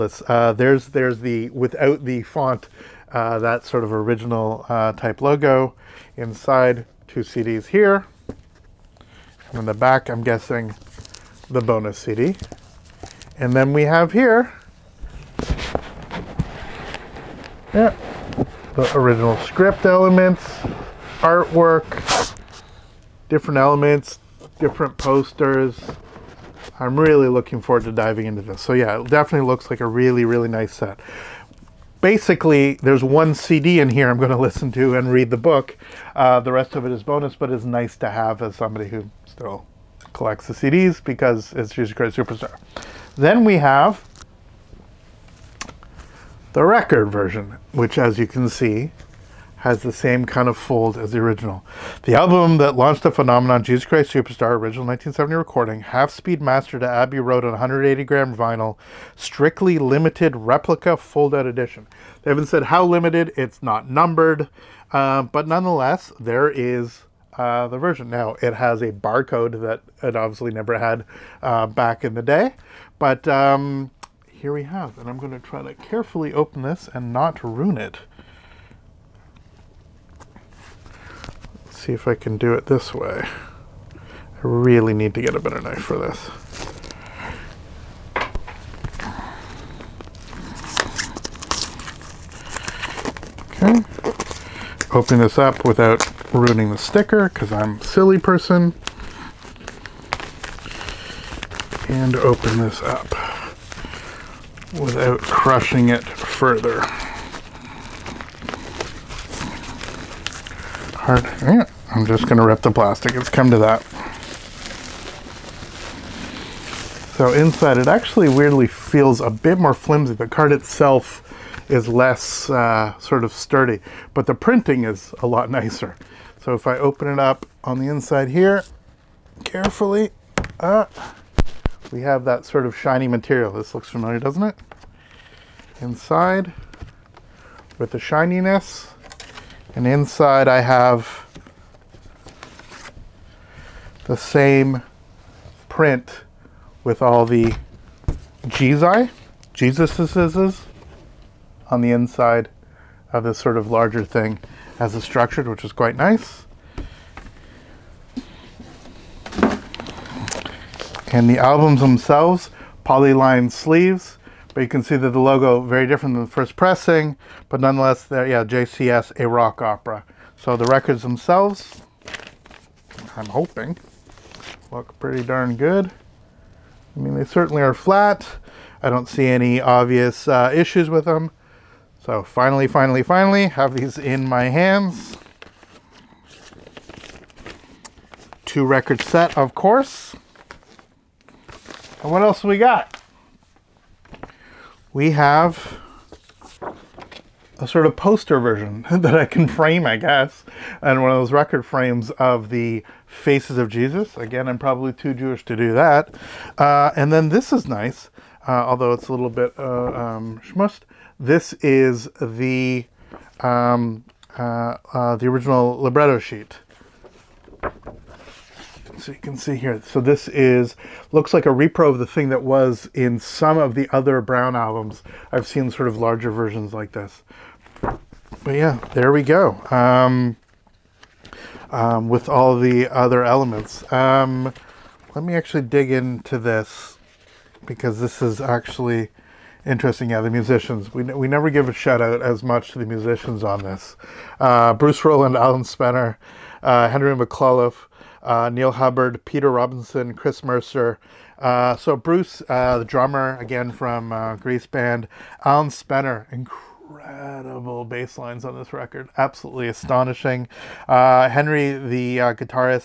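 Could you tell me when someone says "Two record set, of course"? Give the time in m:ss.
3:08.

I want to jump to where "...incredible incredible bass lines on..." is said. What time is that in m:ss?
4:16.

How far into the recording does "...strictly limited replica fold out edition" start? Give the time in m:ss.
0:59.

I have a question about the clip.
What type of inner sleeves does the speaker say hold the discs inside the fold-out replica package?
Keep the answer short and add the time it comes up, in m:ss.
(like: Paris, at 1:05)
polyline sleeves, at 2:42.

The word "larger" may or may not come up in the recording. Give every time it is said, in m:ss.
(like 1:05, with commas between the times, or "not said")
2:33, 3:45.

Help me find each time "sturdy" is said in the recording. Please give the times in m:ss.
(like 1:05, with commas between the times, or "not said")
2:03.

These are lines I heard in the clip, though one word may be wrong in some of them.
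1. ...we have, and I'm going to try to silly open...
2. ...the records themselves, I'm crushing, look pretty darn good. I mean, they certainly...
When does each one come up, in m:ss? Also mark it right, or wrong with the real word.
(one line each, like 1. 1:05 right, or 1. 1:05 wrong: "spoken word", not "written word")
1. 1:14 wrong: "carefully", not "silly"
2. 2:50 wrong: "hoping", not "crushing".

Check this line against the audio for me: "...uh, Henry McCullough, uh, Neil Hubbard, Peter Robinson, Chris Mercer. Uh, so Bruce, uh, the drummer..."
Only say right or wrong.
right.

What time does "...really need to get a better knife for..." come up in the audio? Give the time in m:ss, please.
1:24.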